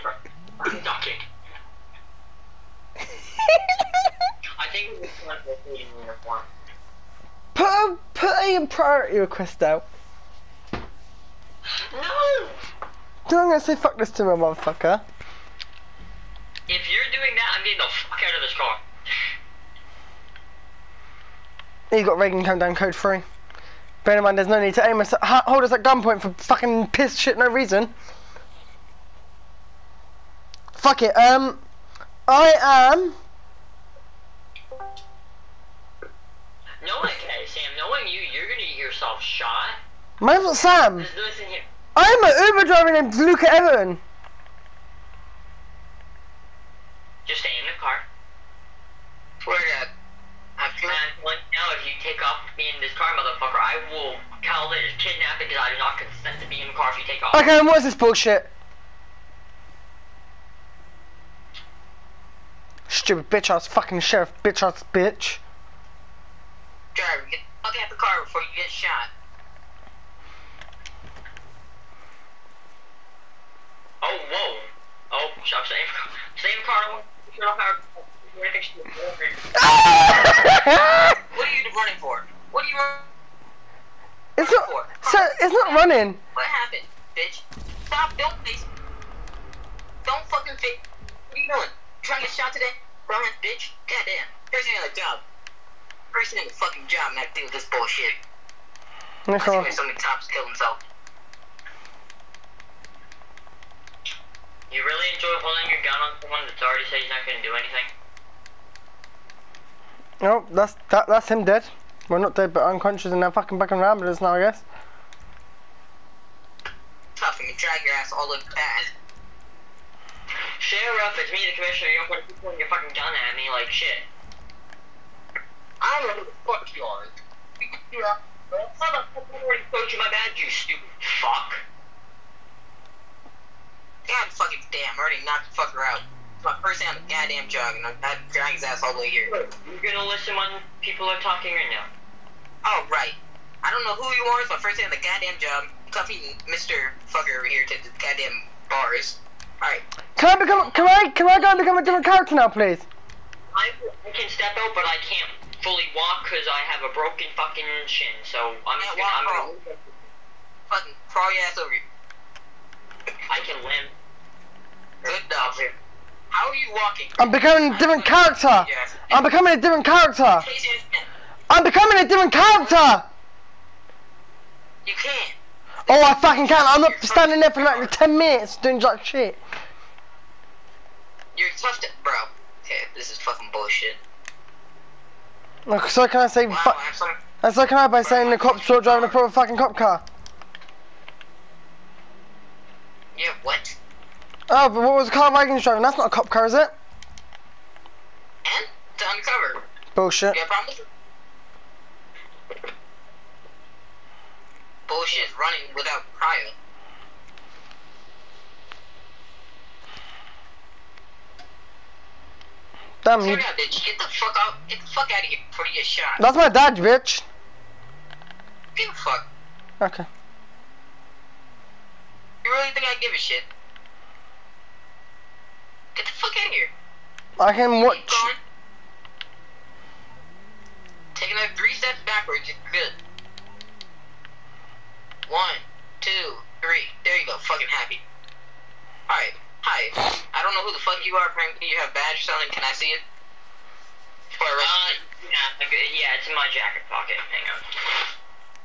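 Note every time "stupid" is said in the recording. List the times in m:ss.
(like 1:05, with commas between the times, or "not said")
1:02, 2:10.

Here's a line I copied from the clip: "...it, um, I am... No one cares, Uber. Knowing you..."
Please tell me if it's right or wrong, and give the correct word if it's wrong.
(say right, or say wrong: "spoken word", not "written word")
wrong: "Sam", not "Uber".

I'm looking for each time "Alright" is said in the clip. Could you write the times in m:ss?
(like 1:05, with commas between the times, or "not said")
2:29, 3:59.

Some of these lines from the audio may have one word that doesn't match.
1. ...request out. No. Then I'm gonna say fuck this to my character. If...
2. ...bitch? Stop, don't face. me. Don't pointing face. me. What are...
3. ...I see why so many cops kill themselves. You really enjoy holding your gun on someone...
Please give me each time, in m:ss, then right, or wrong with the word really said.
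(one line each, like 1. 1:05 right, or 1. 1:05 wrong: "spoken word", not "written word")
1. 0:09 wrong: "motherfucker", not "character"
2. 1:27 wrong: "fucking", not "pointing"
3. 1:39 right.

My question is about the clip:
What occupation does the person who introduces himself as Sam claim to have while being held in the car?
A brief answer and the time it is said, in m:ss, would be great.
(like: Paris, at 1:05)
Uber driver, at 0:42.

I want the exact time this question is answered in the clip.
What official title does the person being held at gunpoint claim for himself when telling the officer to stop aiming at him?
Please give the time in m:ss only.
2:01.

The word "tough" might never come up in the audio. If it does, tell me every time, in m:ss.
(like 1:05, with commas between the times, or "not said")
1:57, 3:01.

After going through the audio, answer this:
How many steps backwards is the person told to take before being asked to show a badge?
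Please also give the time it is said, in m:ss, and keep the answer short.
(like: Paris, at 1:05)
3, at 3:51.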